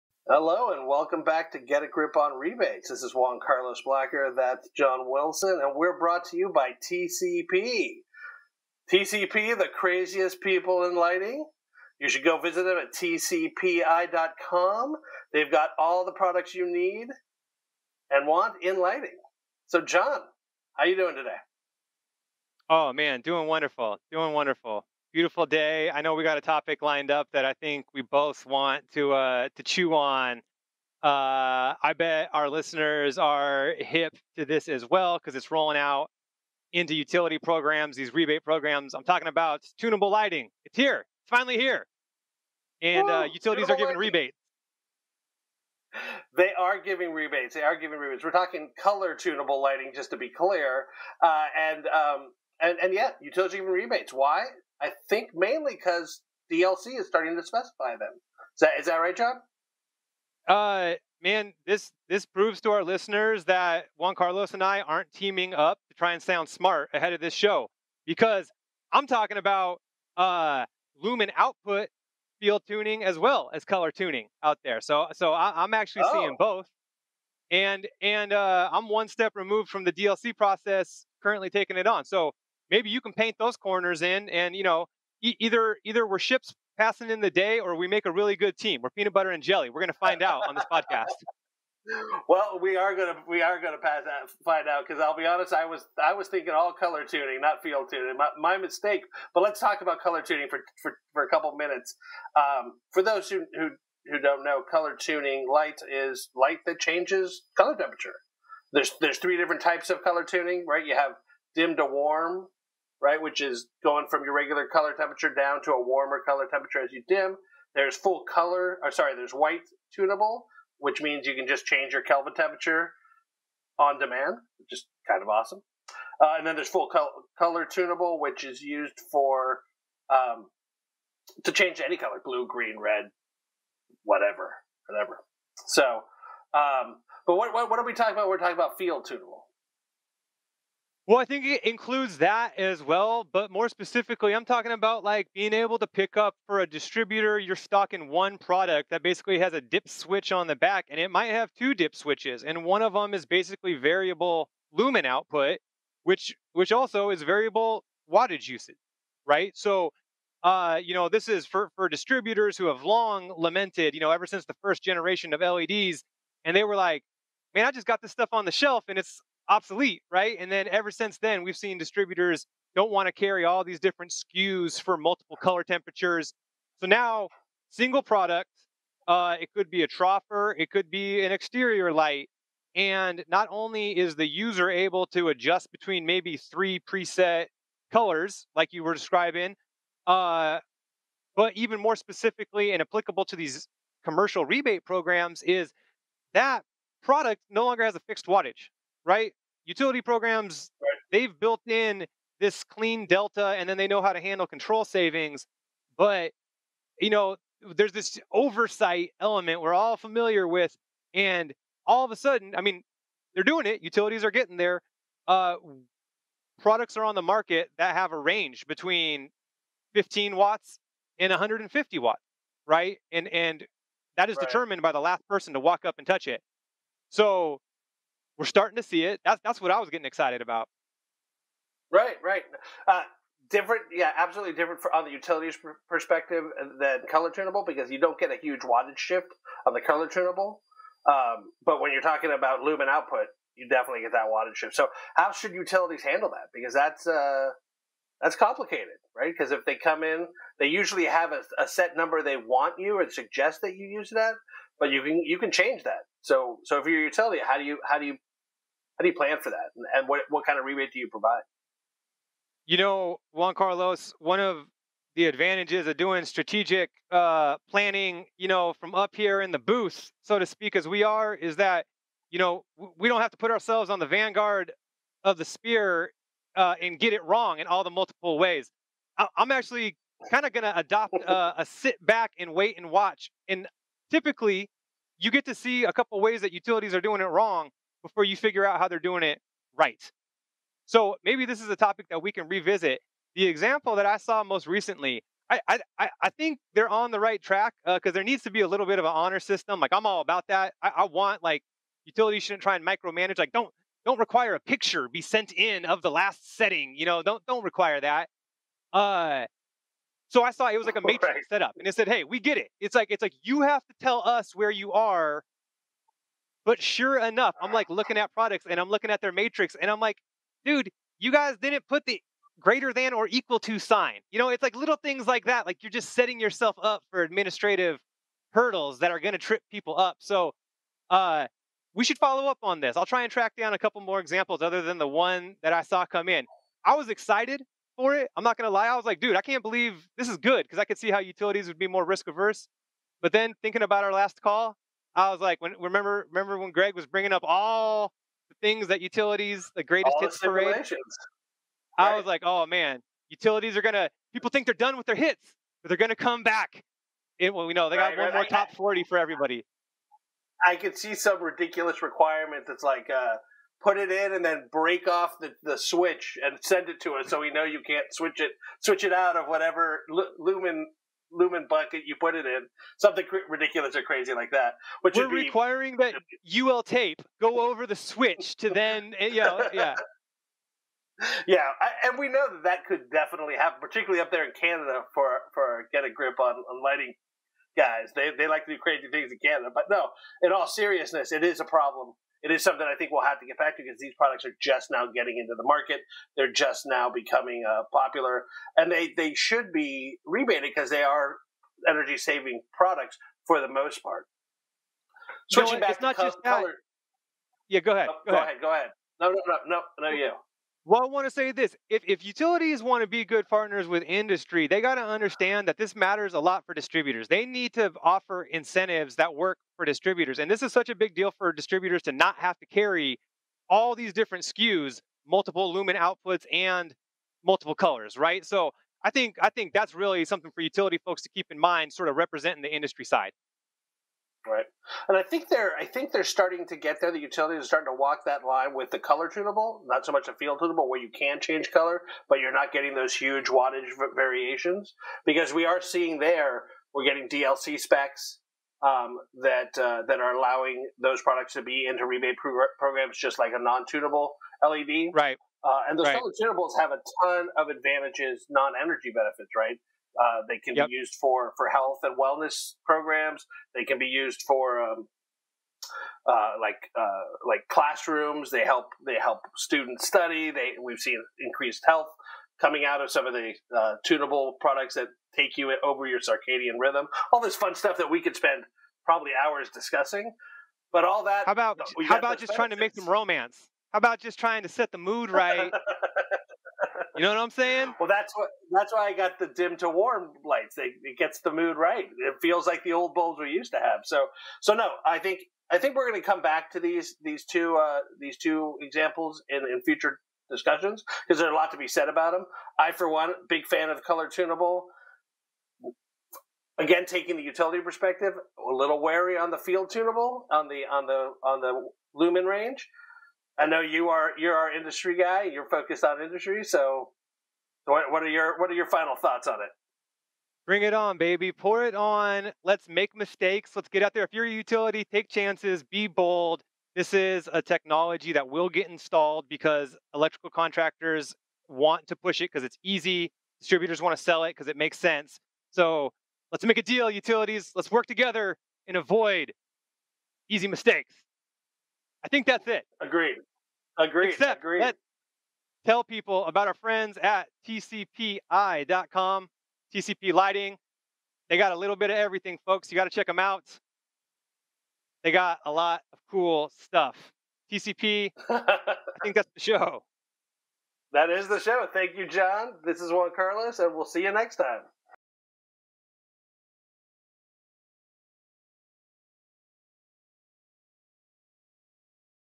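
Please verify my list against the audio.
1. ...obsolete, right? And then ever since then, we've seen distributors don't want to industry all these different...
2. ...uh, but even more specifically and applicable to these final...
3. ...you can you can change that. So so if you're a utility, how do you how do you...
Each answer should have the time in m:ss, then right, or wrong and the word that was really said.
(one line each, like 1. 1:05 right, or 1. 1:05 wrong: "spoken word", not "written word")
1. 2:49 wrong: "carry", not "industry"
2. 3:10 wrong: "commercial", not "final"
3. 4:14 right.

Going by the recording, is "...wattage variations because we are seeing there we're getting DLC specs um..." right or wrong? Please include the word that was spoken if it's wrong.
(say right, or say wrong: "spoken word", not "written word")
right.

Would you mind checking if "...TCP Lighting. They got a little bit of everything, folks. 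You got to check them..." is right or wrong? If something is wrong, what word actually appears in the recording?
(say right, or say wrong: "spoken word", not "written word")
right.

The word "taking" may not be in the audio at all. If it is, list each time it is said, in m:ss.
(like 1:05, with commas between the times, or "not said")
1:21, 8:27.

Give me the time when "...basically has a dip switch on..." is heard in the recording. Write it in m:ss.
2:29.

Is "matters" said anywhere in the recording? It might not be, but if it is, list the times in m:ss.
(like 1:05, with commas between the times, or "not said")
6:55.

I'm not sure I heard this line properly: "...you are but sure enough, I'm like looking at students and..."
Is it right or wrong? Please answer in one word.
wrong.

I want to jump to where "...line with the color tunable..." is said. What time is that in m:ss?
7:18.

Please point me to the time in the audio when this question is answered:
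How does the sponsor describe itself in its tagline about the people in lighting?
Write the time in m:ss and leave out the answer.
0:09.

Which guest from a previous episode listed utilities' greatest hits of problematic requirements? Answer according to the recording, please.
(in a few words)
Greg.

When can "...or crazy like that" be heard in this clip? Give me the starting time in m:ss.
6:13.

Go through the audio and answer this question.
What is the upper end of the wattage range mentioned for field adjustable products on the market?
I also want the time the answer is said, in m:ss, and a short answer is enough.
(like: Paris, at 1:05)
150 watts, at 3:41.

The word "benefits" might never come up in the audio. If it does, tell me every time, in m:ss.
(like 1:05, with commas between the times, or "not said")
7:39, 8:02.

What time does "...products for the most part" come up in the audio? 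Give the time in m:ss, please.
6:42.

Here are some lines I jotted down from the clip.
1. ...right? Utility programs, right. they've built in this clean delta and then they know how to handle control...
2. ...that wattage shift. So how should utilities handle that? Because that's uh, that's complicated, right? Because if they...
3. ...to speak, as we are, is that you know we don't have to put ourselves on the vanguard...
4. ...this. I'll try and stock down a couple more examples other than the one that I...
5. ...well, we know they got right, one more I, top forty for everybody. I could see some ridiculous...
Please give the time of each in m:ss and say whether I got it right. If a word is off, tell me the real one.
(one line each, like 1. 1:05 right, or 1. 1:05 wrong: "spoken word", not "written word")
1. 3:19 right
2. 4:04 right
3. 4:30 right
4. 5:32 wrong: "track", not "stock"
5. 5:57 right.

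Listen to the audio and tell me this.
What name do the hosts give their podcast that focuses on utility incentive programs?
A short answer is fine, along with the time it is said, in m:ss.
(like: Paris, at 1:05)
Get a Grip on Rebates, at 0:01.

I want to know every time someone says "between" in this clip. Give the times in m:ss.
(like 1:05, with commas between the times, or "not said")
3:05, 3:38.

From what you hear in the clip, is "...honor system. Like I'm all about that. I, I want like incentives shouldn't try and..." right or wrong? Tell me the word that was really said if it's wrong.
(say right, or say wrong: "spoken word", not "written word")
wrong: "utilities", not "incentives".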